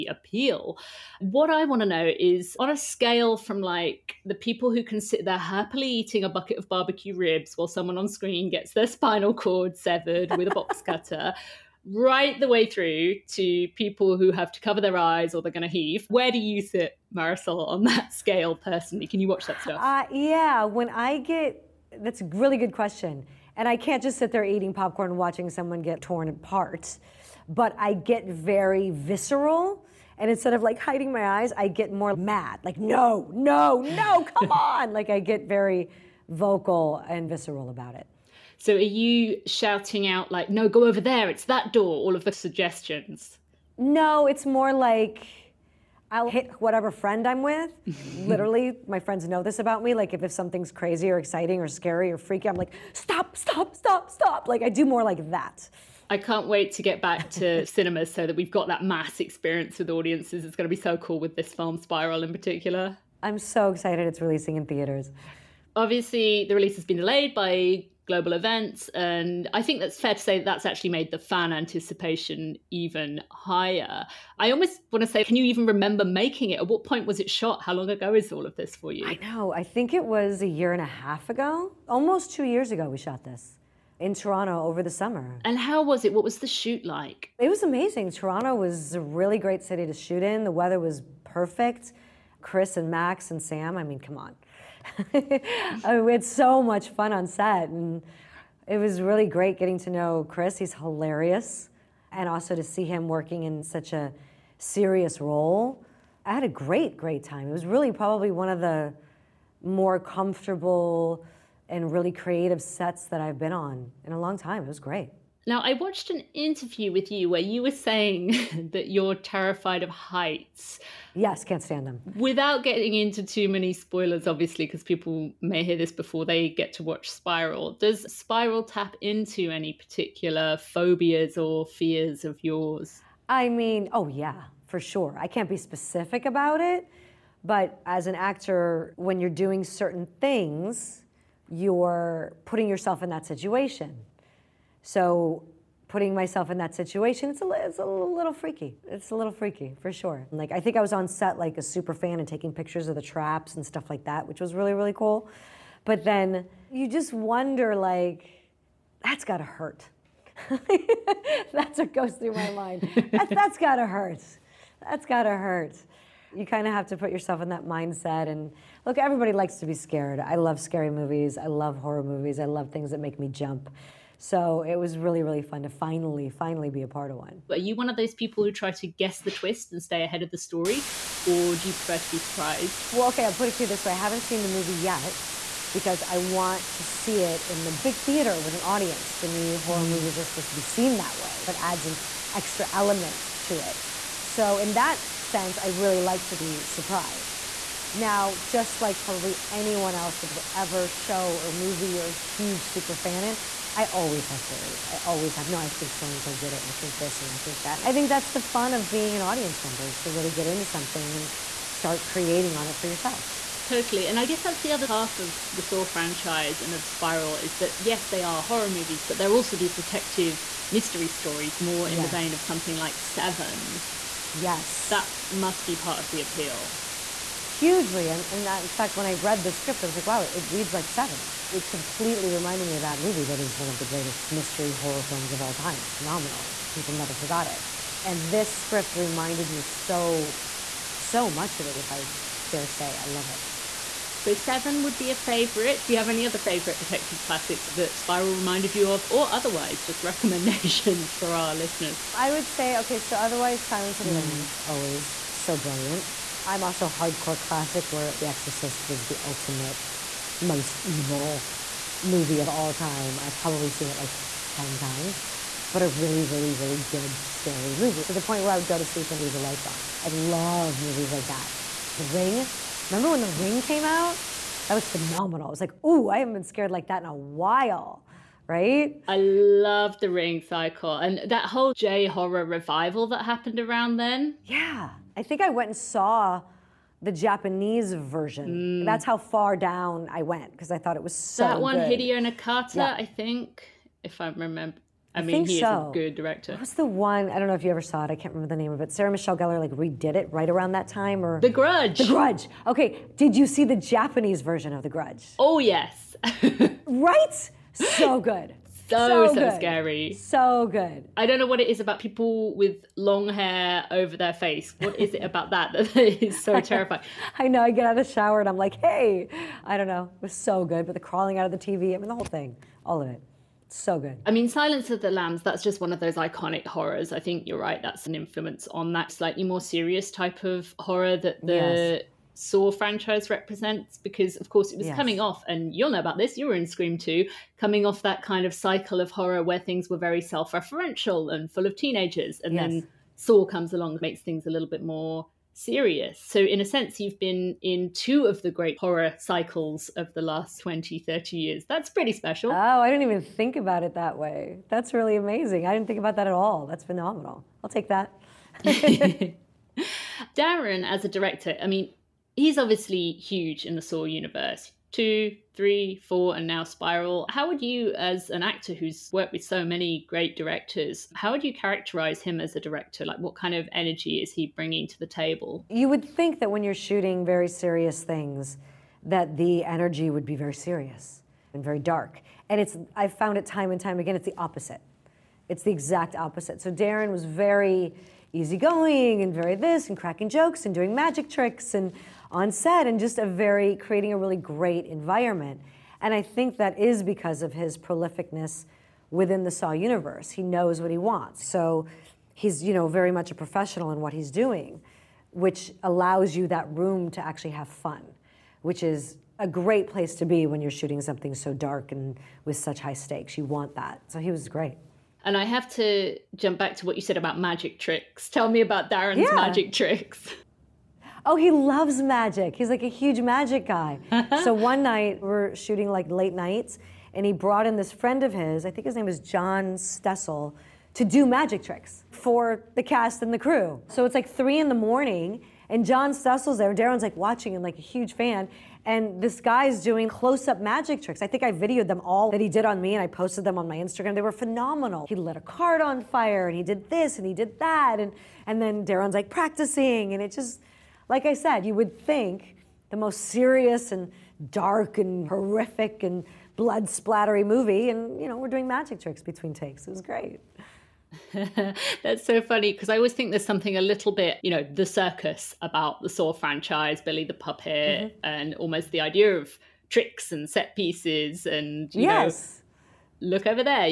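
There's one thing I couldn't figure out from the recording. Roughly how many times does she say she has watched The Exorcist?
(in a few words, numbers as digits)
10.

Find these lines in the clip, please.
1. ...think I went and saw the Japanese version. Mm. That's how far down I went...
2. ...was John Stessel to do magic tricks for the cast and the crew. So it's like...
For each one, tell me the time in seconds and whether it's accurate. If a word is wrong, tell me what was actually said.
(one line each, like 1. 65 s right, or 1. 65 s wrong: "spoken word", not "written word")
1. 285 s right
2. 429 s right.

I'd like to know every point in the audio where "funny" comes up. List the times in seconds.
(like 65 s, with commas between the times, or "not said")
462 s.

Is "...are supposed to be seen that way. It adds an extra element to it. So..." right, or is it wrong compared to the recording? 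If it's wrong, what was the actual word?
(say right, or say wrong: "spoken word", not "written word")
right.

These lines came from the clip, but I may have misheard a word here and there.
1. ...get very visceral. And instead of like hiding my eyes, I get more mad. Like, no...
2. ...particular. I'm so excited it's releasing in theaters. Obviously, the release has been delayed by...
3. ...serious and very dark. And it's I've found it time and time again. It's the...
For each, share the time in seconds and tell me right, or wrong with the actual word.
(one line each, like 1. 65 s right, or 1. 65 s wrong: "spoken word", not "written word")
1. 27 s right
2. 62 s right
3. 380 s right.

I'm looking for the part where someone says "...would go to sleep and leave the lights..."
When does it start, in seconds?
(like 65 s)
268 s.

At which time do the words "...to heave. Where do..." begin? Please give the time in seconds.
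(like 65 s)
15 s.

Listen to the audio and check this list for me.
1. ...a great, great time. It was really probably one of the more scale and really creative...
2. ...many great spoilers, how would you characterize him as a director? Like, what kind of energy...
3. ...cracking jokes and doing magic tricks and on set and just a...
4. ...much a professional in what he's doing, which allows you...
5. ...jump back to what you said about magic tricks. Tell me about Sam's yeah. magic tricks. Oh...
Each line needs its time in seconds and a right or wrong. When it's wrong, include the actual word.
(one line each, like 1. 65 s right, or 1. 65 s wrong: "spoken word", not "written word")
1. 106 s wrong: "comfortable", not "scale"
2. 369 s wrong: "directors", not "spoilers"
3. 389 s right
4. 403 s right
5. 416 s wrong: "Darren", not "Sam".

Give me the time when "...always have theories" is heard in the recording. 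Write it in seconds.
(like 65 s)
203 s.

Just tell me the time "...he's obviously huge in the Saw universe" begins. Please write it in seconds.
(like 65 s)
362 s.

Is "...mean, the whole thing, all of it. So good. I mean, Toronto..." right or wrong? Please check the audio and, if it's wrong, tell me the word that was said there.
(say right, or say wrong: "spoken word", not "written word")
wrong: "Silence", not "Toronto".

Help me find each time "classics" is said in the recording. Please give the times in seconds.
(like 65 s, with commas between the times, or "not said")
247 s, 257 s.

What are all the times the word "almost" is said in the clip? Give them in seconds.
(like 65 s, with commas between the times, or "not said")
74 s, 81 s, 468 s.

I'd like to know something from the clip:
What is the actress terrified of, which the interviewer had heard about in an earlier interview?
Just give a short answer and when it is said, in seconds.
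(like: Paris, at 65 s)
Heights, at 119 s.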